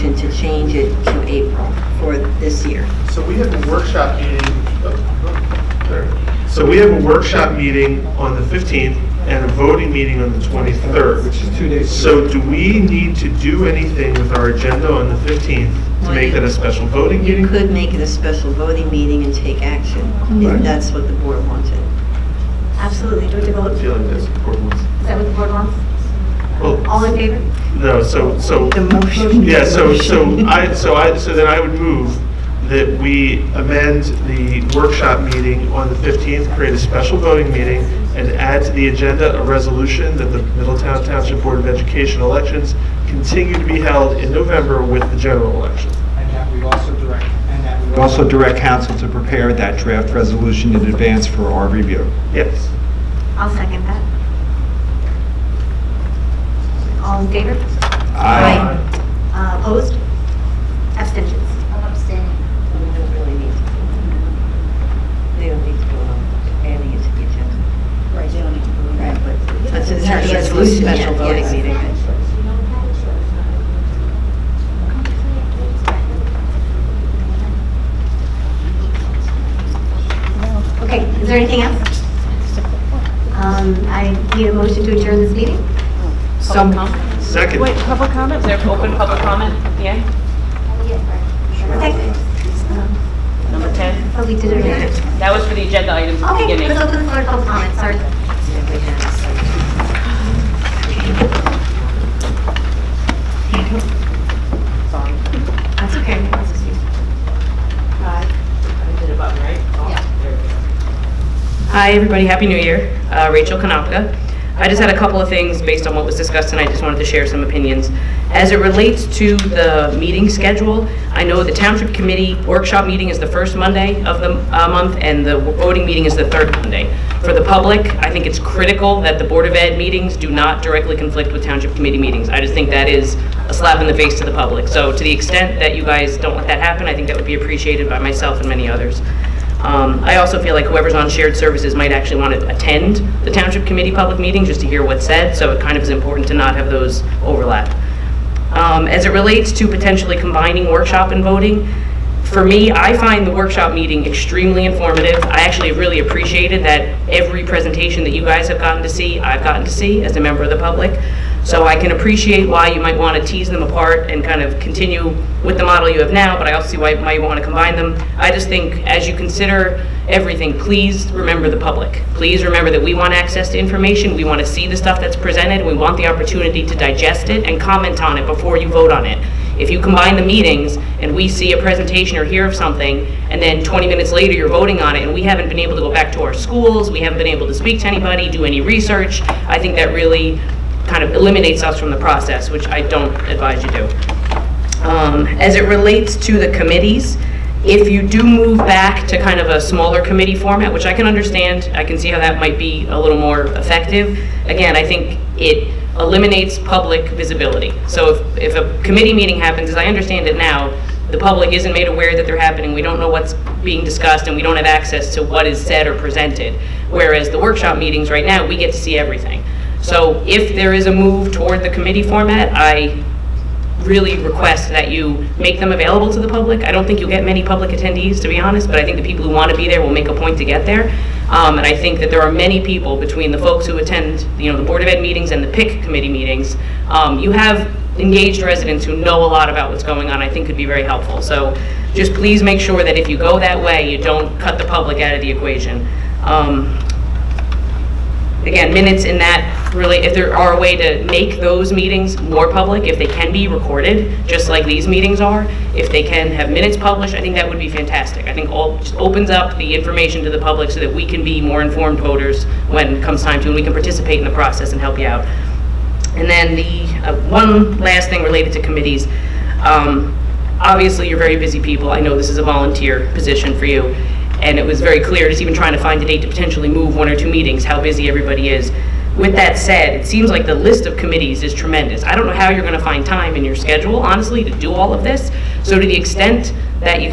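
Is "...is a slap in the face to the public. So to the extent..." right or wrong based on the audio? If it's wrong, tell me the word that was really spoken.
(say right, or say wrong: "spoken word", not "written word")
right.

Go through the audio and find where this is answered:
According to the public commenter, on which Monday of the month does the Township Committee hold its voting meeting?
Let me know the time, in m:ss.
2:06.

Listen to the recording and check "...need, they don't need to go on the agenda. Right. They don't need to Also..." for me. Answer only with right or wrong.
wrong.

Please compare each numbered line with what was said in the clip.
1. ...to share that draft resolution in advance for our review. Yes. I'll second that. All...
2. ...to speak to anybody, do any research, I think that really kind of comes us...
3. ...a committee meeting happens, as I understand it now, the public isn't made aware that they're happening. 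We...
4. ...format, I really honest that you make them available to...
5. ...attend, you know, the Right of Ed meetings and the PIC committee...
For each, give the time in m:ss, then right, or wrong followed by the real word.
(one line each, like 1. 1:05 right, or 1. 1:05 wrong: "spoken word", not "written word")
1. 0:48 wrong: "prepare", not "share"
2. 3:07 wrong: "eliminates", not "comes"
3. 3:28 right
4. 3:42 wrong: "request", not "honest"
5. 3:53 wrong: "Board", not "Right".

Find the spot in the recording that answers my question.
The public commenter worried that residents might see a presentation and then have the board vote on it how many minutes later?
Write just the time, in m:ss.
3:03.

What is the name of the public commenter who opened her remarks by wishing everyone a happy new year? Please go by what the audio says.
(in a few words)
Rachel Kanopka.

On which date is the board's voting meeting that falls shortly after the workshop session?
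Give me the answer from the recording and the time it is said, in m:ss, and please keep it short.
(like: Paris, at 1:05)
23rd, at 0:10.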